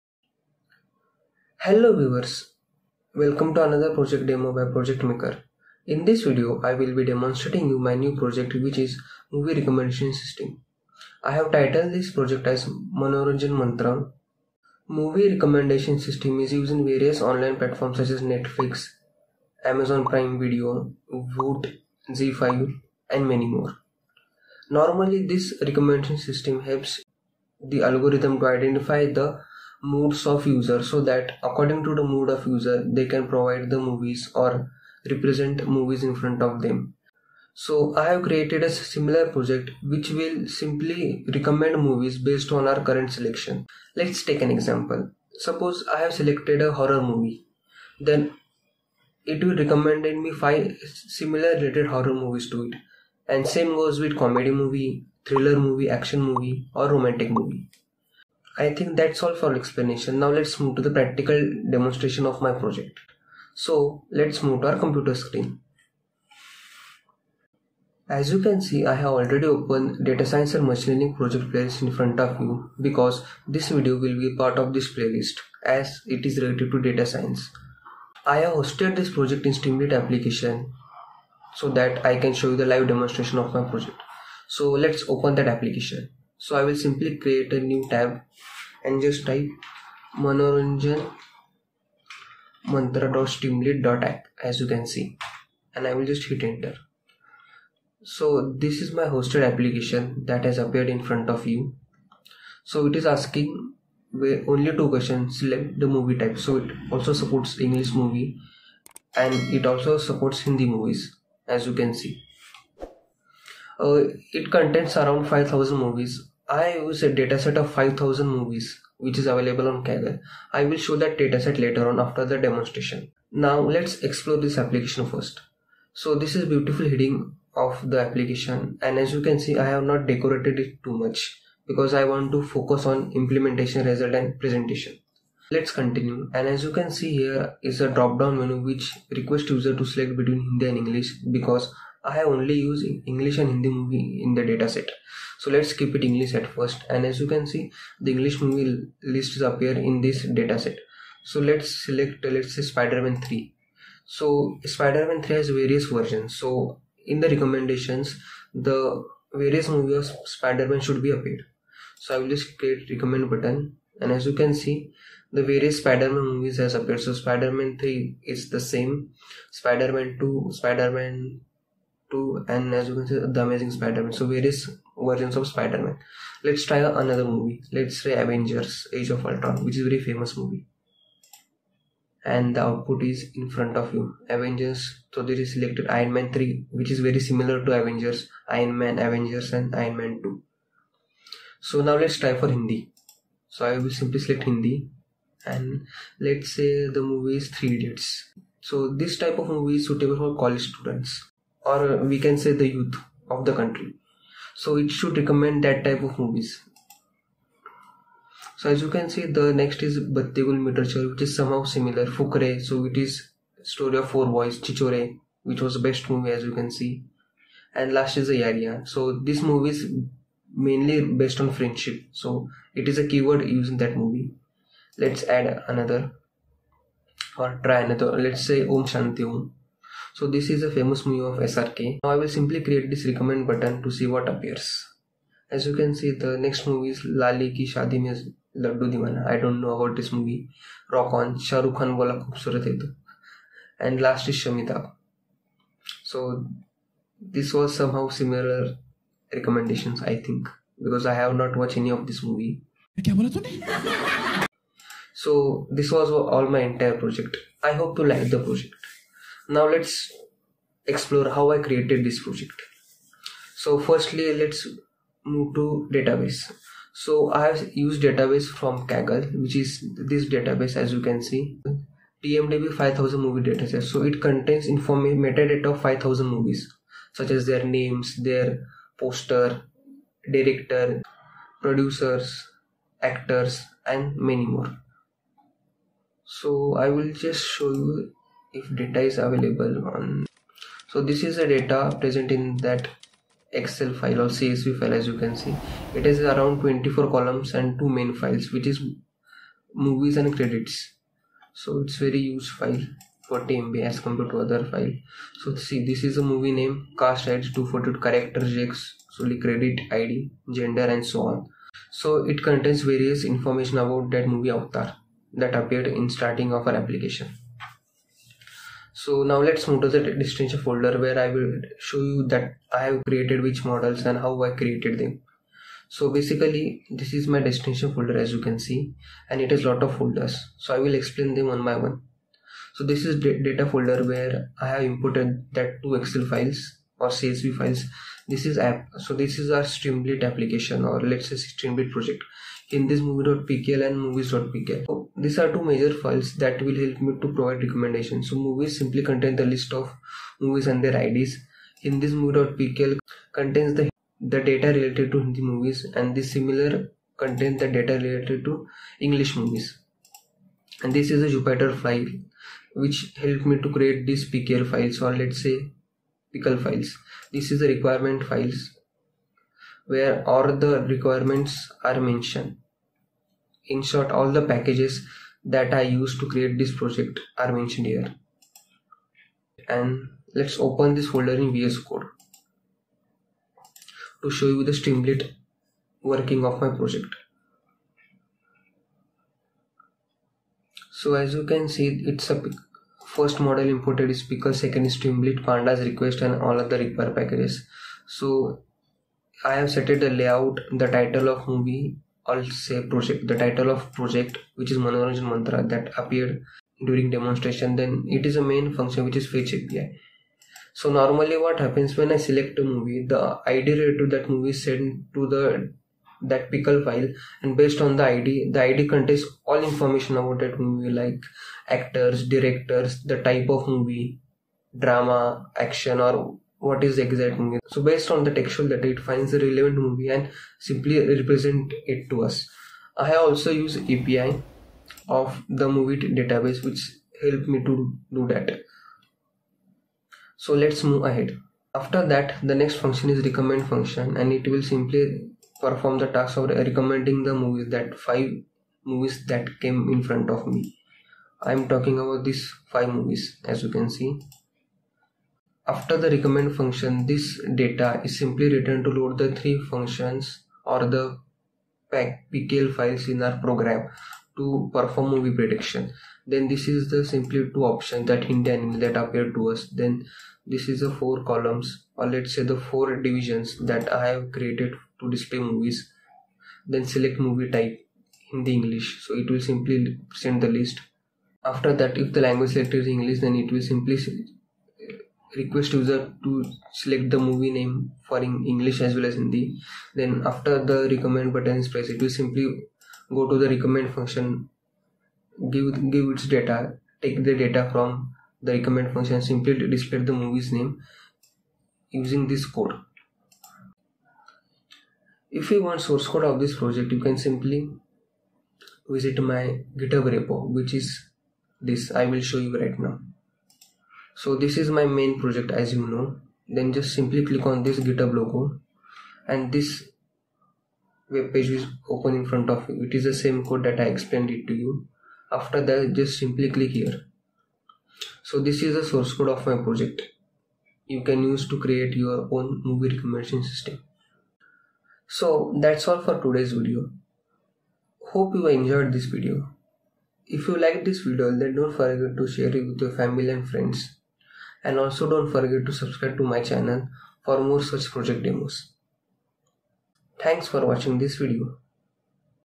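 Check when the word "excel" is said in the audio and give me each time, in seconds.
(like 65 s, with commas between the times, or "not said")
293 s, 335 s.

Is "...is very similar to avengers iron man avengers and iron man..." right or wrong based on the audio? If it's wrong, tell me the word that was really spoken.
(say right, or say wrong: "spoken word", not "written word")
right.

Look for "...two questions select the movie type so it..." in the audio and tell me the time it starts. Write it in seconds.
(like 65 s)
104 s.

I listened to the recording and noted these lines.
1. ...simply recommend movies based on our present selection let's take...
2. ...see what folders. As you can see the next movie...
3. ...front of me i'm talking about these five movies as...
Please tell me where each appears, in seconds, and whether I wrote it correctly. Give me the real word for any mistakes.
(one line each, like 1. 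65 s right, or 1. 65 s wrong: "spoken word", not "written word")
1. 40 s wrong: "current", not "present"
2. 233 s wrong: "appears", not "folders"
3. 450 s right.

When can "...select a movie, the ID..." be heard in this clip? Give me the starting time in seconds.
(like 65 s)
412 s.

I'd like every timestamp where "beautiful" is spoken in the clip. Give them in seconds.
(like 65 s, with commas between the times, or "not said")
126 s.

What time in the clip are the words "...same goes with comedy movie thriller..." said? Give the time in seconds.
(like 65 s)
53 s.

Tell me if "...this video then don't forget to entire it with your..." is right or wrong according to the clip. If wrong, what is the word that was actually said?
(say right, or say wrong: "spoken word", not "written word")
wrong: "share", not "entire".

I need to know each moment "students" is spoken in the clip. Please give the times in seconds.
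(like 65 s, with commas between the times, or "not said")
200 s.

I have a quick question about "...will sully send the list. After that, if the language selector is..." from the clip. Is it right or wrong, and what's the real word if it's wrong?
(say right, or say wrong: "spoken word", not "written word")
wrong: "simply", not "sully".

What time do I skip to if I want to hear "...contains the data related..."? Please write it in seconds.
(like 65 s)
357 s.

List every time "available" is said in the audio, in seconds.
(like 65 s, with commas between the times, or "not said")
119 s, 289 s.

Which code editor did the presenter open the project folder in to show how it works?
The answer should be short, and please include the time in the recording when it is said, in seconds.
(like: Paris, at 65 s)
VS Code, at 381 s.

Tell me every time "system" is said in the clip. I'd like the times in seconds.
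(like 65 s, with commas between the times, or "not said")
10 s, 15 s, 26 s, 533 s.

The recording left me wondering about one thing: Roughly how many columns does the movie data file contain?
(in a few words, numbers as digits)
24.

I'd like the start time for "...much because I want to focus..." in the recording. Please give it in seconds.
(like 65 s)
130 s.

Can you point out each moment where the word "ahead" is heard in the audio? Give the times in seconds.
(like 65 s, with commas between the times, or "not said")
441 s.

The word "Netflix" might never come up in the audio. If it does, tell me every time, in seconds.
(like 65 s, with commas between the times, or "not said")
18 s.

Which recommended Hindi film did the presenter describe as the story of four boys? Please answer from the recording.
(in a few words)
Fukrey.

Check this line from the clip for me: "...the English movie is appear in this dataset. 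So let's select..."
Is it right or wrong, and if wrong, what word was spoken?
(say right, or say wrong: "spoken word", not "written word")
right.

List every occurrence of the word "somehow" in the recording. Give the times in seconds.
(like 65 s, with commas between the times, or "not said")
211 s, 247 s.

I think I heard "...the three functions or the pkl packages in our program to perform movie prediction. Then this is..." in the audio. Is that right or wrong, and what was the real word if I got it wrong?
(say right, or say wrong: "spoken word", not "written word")
wrong: "files", not "packages".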